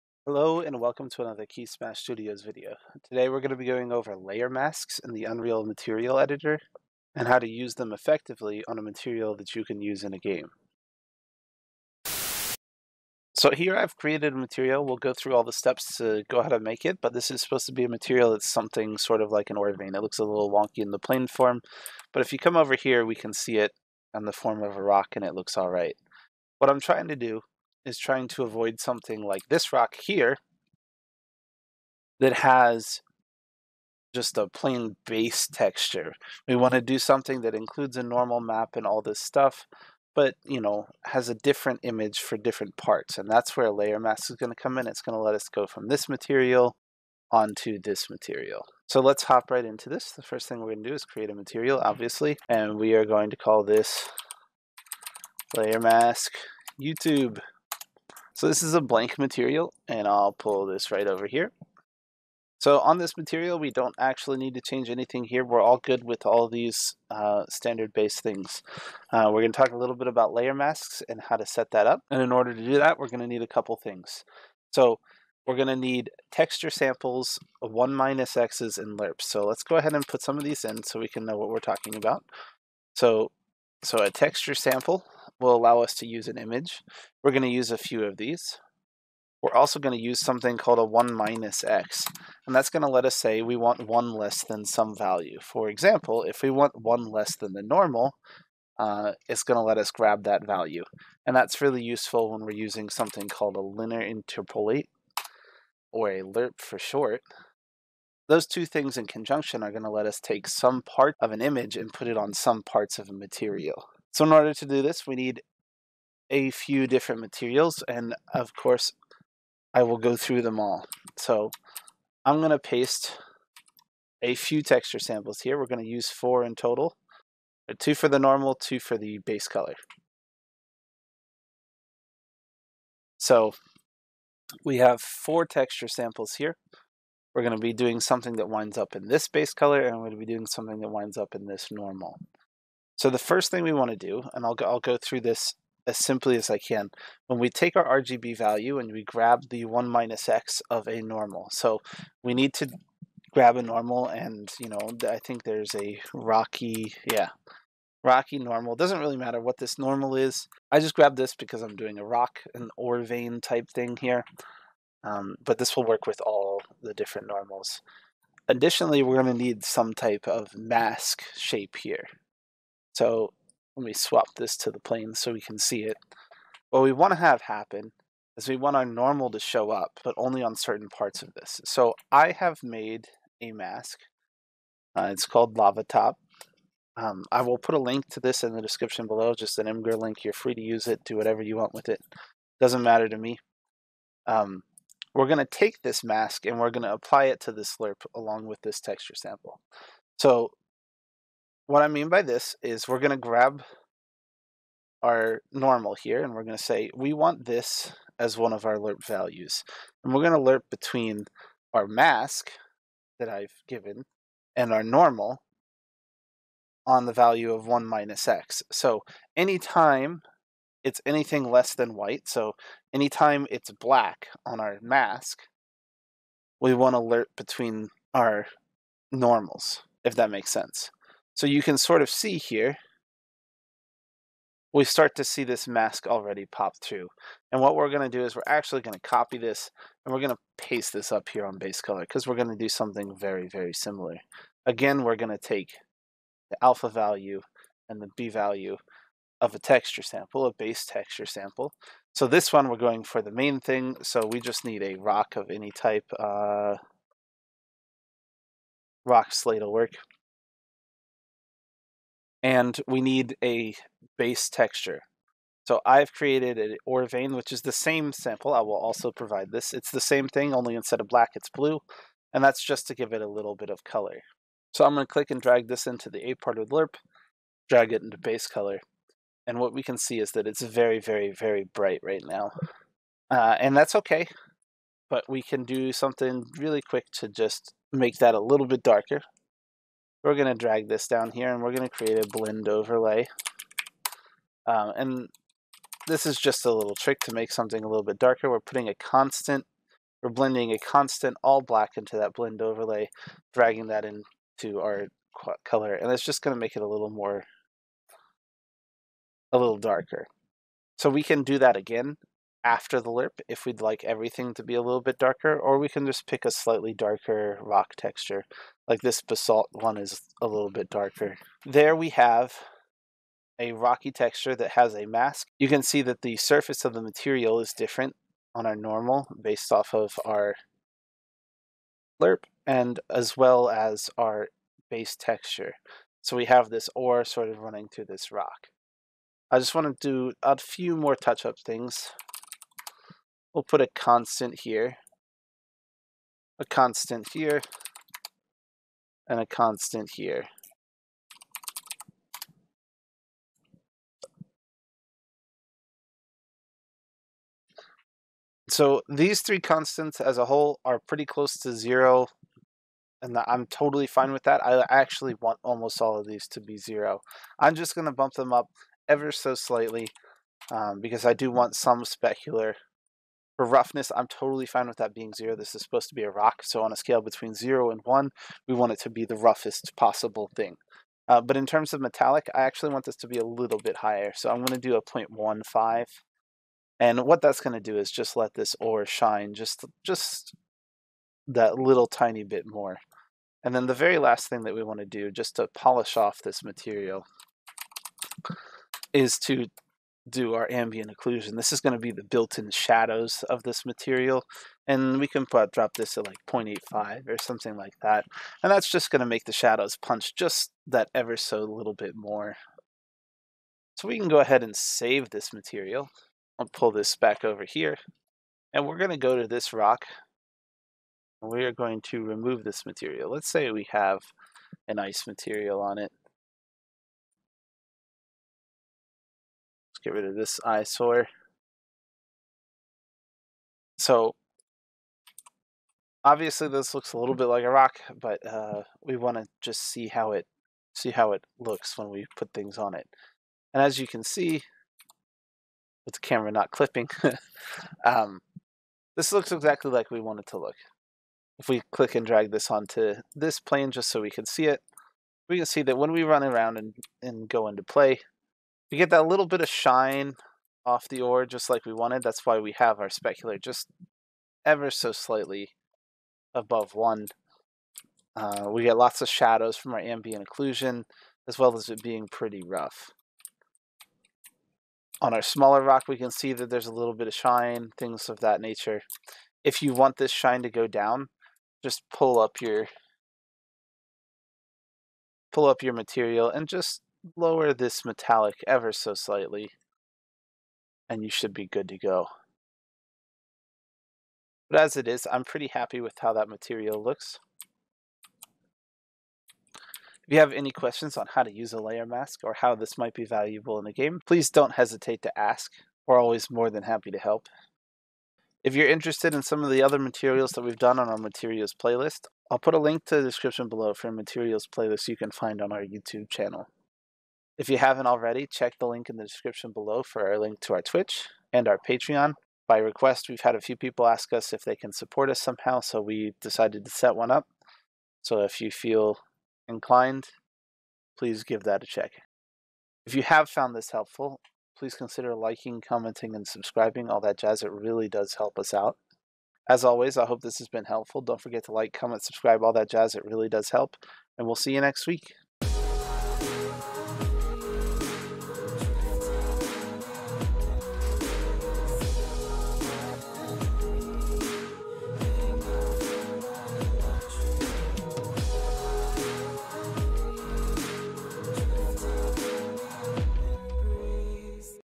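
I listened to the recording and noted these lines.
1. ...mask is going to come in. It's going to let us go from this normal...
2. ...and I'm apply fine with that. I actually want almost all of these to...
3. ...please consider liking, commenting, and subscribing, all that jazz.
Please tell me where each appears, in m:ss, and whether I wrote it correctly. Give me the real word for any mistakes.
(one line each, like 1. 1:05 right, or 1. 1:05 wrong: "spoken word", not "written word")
1. 0:43 wrong: "material", not "normal"
2. 6:03 wrong: "totally", not "apply"
3. 8:54 right.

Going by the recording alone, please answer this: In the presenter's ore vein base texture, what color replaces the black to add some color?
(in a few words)
Blue.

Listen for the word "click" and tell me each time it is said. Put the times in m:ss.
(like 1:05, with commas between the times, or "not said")
4:35, 7:31.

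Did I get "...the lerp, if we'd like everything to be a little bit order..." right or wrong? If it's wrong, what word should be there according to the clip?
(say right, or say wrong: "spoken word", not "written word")
wrong: "darker", not "order".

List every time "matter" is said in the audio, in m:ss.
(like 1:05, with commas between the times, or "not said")
2:39, 3:12.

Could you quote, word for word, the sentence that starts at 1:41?
And that's really useful when we're using something called a linear interpolate, or a LERP for short.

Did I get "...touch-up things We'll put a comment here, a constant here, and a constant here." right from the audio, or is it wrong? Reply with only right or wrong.
wrong.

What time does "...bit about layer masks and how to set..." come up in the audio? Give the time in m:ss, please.
1:09.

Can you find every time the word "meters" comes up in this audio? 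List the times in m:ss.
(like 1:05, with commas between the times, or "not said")
not said.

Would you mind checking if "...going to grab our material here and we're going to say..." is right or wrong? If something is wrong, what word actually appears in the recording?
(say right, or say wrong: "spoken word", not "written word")
wrong: "normal", not "material".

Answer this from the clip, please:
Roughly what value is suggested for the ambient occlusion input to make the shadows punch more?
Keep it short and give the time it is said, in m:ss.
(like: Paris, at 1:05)
0.85, at 6:46.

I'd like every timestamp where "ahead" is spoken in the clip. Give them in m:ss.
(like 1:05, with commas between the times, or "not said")
1:19, 6:54.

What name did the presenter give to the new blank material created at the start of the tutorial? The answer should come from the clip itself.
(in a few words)
Layer mask YouTube.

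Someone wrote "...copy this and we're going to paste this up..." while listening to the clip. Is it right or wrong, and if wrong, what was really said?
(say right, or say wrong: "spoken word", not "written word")
right.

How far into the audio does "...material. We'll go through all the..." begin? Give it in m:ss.
0:14.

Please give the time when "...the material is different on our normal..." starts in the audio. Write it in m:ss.
5:26.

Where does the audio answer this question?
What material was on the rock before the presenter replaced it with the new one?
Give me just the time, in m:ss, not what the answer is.
7:04.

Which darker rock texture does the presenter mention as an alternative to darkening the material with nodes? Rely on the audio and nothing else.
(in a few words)
Basalt.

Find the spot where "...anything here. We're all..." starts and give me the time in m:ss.
1:04.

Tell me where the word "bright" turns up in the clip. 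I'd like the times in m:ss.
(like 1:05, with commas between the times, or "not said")
4:41.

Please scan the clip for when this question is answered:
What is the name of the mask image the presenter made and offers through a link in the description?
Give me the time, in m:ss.
3:05.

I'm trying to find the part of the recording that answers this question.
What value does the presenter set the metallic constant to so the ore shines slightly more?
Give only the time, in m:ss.
6:25.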